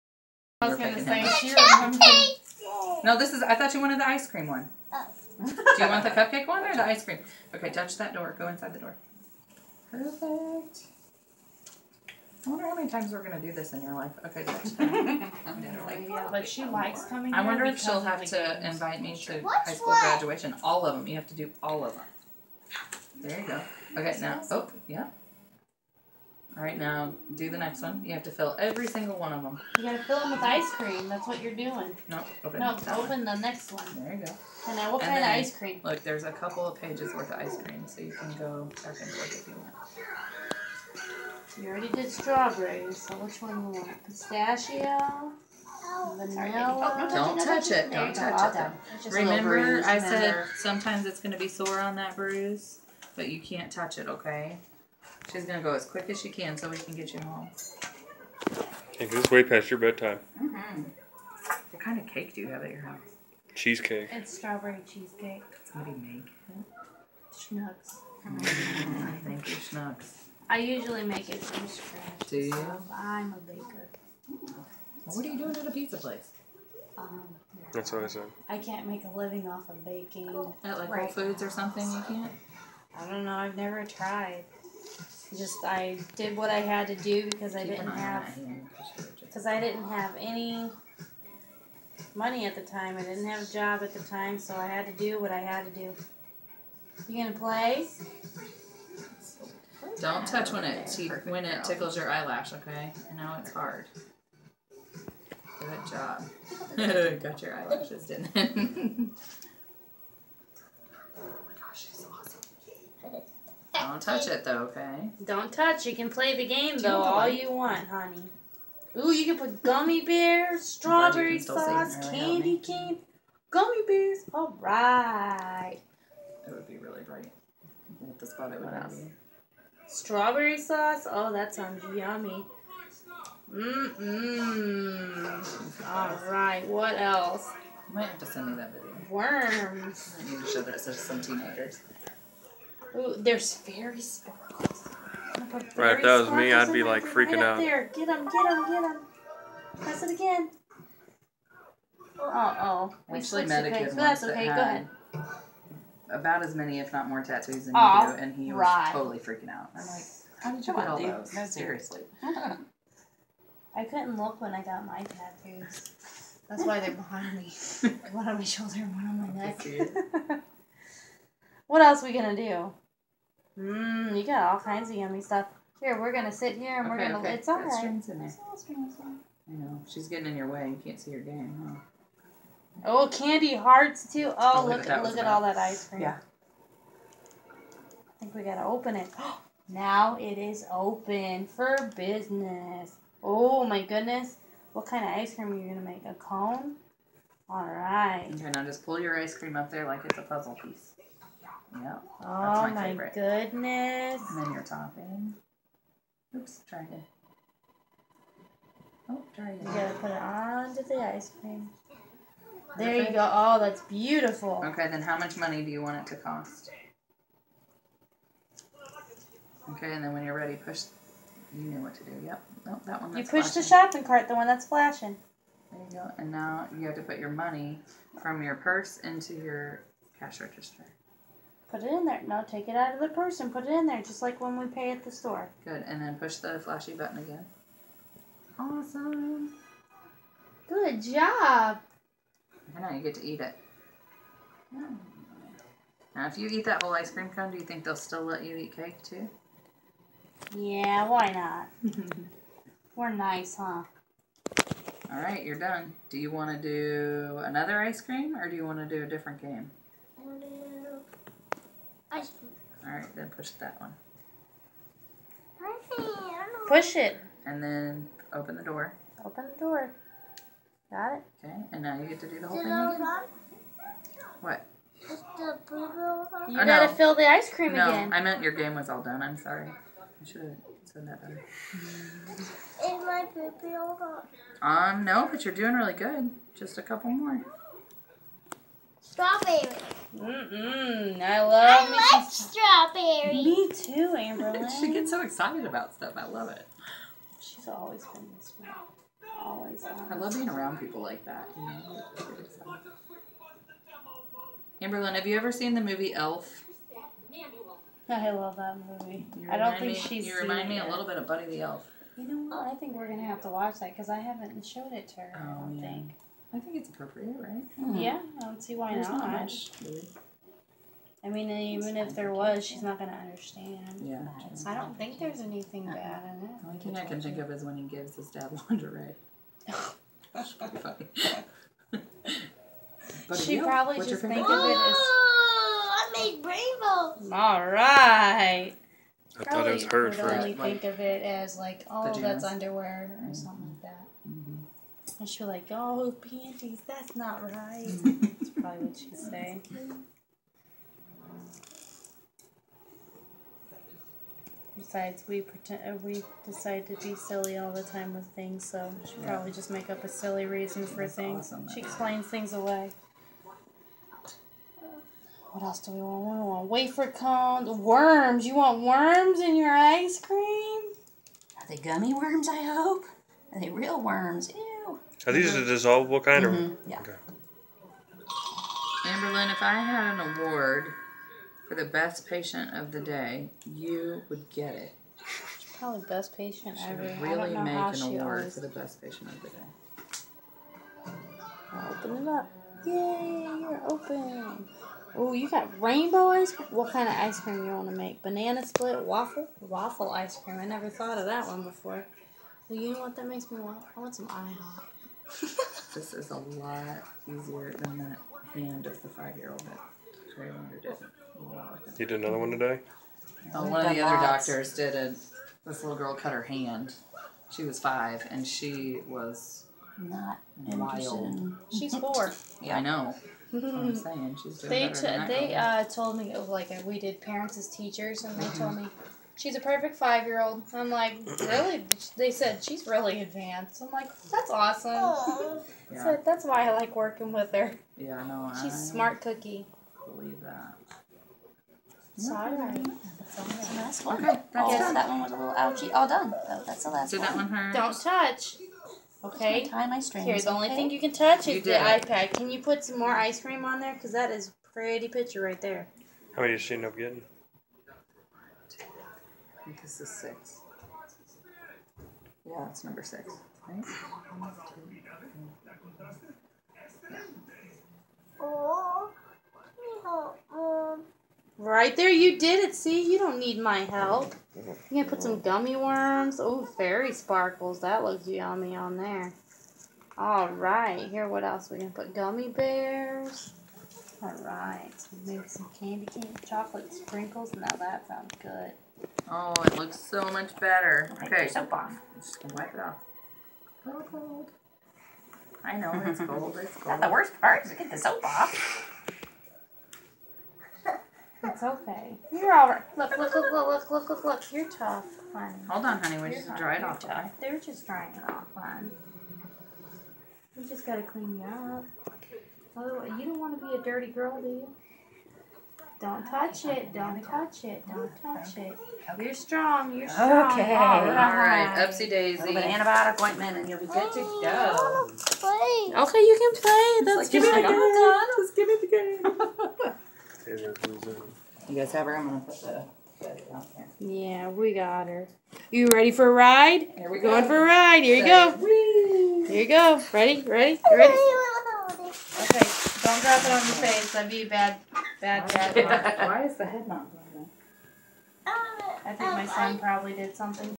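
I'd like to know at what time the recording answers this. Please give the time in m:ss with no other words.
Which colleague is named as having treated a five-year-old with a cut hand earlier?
6:50.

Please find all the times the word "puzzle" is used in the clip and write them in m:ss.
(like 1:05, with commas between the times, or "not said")
3:20.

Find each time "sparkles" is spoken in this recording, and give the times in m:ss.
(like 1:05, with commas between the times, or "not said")
2:24, 7:57.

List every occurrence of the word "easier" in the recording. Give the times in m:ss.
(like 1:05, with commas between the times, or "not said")
6:47.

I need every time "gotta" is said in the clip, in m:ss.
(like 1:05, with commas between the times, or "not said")
0:29, 3:08, 3:29, 4:36, 8:30.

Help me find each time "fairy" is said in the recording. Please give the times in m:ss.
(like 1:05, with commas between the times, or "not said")
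2:23, 7:56.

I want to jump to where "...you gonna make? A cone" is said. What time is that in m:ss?
3:15.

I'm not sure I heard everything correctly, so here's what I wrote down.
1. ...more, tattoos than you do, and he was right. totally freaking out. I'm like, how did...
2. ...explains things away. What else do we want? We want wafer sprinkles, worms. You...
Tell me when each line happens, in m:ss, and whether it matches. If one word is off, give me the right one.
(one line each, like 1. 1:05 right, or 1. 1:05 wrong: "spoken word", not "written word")
1. 2:37 right
2. 6:01 wrong: "cones", not "sprinkles".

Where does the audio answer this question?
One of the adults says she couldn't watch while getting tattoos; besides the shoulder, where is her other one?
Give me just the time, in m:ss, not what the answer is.
2:49.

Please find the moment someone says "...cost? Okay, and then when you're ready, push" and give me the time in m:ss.
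3:36.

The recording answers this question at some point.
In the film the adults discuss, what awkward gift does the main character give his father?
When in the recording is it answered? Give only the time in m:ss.
5:28.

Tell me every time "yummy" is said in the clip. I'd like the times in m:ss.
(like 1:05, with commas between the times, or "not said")
2:11, 2:54, 7:58.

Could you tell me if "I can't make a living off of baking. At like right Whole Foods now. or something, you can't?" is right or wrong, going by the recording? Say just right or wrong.
right.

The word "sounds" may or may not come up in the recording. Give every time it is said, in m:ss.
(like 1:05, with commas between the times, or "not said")
2:11, 8:08.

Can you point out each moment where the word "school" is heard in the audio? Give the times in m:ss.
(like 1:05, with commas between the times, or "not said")
0:19.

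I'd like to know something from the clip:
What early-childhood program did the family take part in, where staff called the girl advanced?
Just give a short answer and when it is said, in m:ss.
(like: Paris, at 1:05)
Parents as Teachers, at 7:07.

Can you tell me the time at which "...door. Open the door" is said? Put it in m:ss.
4:28.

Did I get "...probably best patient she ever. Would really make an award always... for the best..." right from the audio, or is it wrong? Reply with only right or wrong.
right.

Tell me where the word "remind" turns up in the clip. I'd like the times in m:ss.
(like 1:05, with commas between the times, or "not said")
5:10.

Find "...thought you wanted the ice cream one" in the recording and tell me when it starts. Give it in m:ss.
0:03.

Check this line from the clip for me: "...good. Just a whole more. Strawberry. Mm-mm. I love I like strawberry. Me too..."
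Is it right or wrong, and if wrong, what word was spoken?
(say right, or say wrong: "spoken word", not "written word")
wrong: "couple", not "whole".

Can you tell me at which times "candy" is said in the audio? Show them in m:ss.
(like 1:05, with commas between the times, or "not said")
2:02, 3:03, 8:05.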